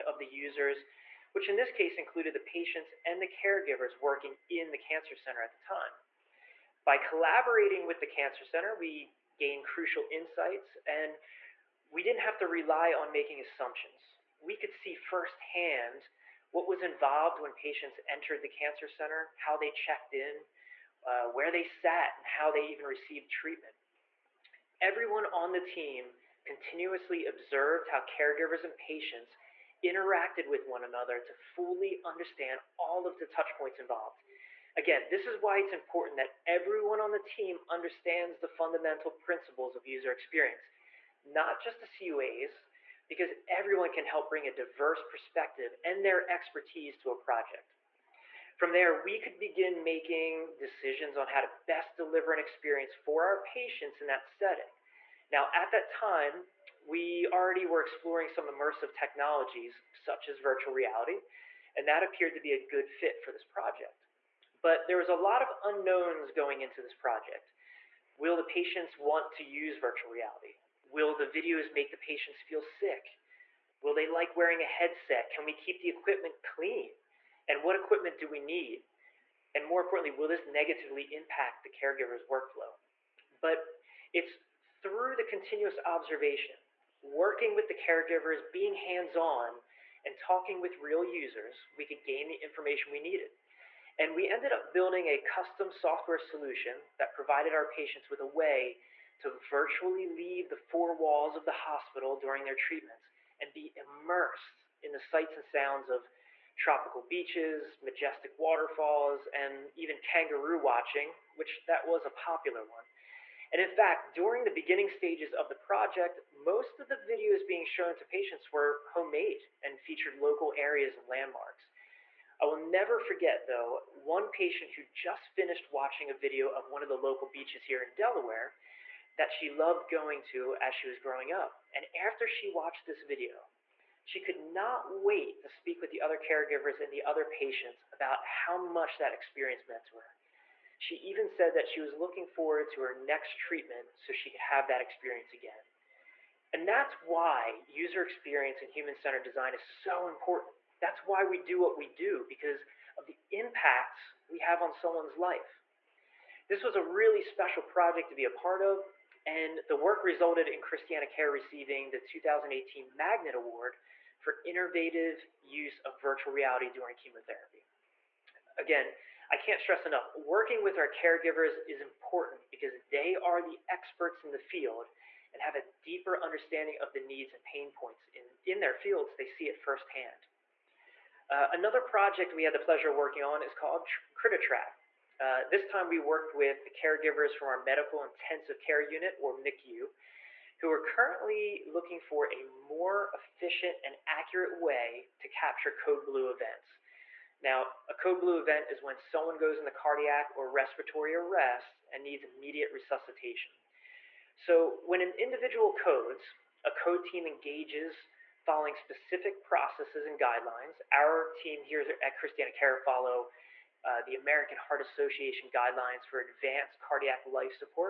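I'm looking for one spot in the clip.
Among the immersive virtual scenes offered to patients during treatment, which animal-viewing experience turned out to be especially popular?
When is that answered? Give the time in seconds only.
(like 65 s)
110 s.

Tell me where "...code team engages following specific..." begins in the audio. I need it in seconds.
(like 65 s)
206 s.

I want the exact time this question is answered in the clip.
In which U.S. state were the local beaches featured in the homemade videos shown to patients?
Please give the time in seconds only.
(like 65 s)
127 s.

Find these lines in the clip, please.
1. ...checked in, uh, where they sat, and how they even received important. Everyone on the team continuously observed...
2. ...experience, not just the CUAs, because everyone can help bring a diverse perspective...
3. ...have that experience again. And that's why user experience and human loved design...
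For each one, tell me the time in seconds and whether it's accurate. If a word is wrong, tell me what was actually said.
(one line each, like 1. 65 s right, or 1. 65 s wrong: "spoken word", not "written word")
1. 19 s wrong: "treatment", not "important"
2. 40 s right
3. 144 s wrong: "centered", not "loved".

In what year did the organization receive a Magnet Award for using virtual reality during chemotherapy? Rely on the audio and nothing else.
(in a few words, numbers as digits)
2018.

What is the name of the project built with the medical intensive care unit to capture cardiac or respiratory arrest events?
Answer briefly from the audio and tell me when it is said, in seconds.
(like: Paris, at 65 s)
Crititrack, at 184 s.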